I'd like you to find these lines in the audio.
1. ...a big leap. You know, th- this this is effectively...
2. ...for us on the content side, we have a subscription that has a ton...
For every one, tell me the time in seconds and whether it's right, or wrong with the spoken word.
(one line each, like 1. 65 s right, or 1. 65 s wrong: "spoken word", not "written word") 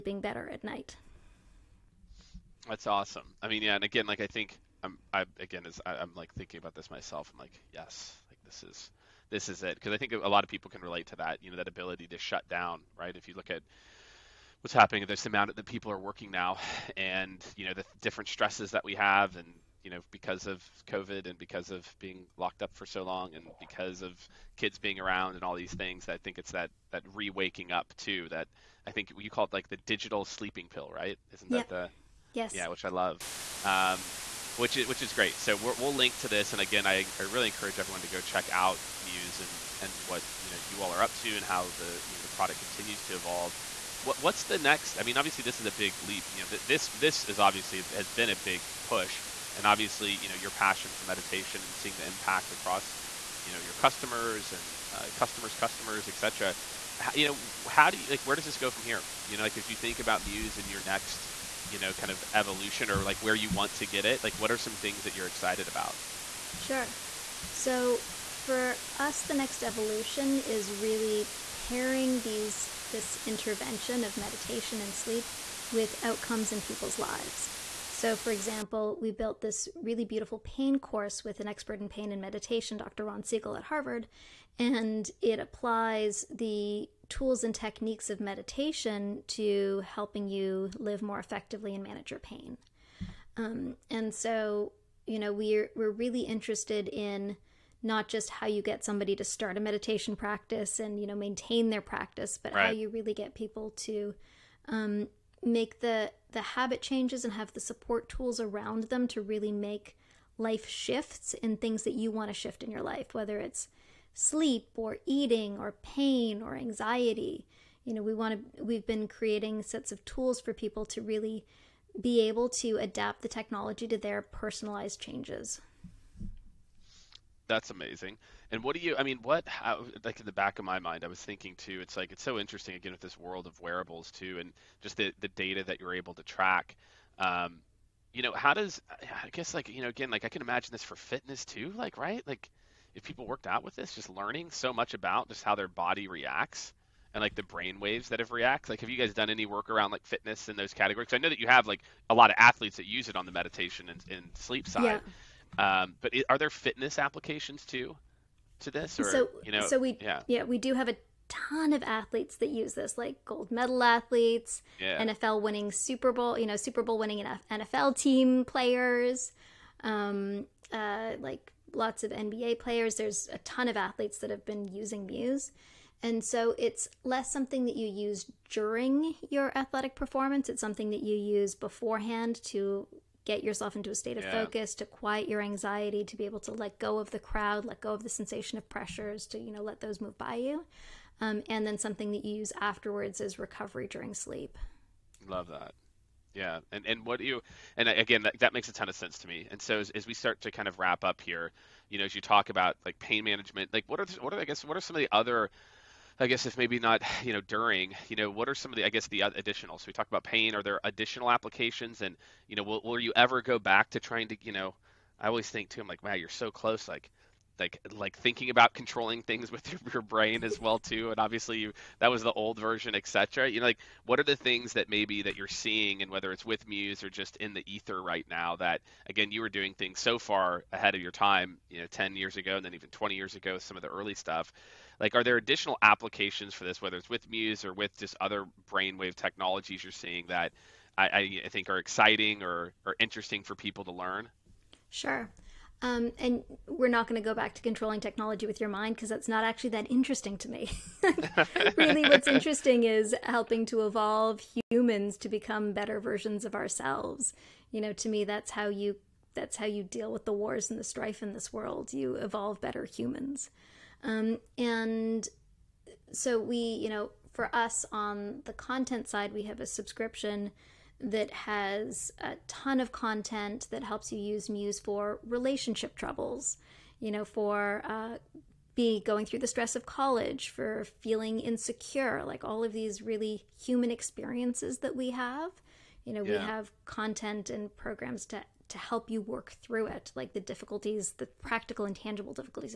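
1. 45 s wrong: "obviously", not "effectively"
2. 267 s right.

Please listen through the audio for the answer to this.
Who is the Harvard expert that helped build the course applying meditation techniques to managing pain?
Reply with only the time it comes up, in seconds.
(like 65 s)
82 s.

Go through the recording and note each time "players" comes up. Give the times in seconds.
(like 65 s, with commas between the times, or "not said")
168 s, 172 s.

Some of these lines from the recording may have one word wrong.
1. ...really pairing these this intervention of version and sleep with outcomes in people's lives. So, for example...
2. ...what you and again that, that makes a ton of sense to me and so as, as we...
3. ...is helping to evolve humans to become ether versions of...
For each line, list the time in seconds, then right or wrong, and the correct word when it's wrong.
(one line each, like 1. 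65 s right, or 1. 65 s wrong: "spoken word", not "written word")
1. 70 s wrong: "meditation", not "version"
2. 197 s right
3. 252 s wrong: "better", not "ether".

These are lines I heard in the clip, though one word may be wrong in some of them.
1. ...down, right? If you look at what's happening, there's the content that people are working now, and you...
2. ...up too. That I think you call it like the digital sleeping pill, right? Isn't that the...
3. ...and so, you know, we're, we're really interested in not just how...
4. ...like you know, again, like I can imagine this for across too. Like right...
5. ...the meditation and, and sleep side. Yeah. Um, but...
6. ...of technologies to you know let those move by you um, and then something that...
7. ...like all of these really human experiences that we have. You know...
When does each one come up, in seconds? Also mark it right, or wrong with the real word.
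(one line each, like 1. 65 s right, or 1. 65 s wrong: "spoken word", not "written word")
1. 12 s wrong: "amount", not "content"
2. 27 s right
3. 93 s right
4. 139 s wrong: "fitness", not "across"
5. 153 s right
6. 188 s wrong: "pressures", not "technologies"
7. 282 s right.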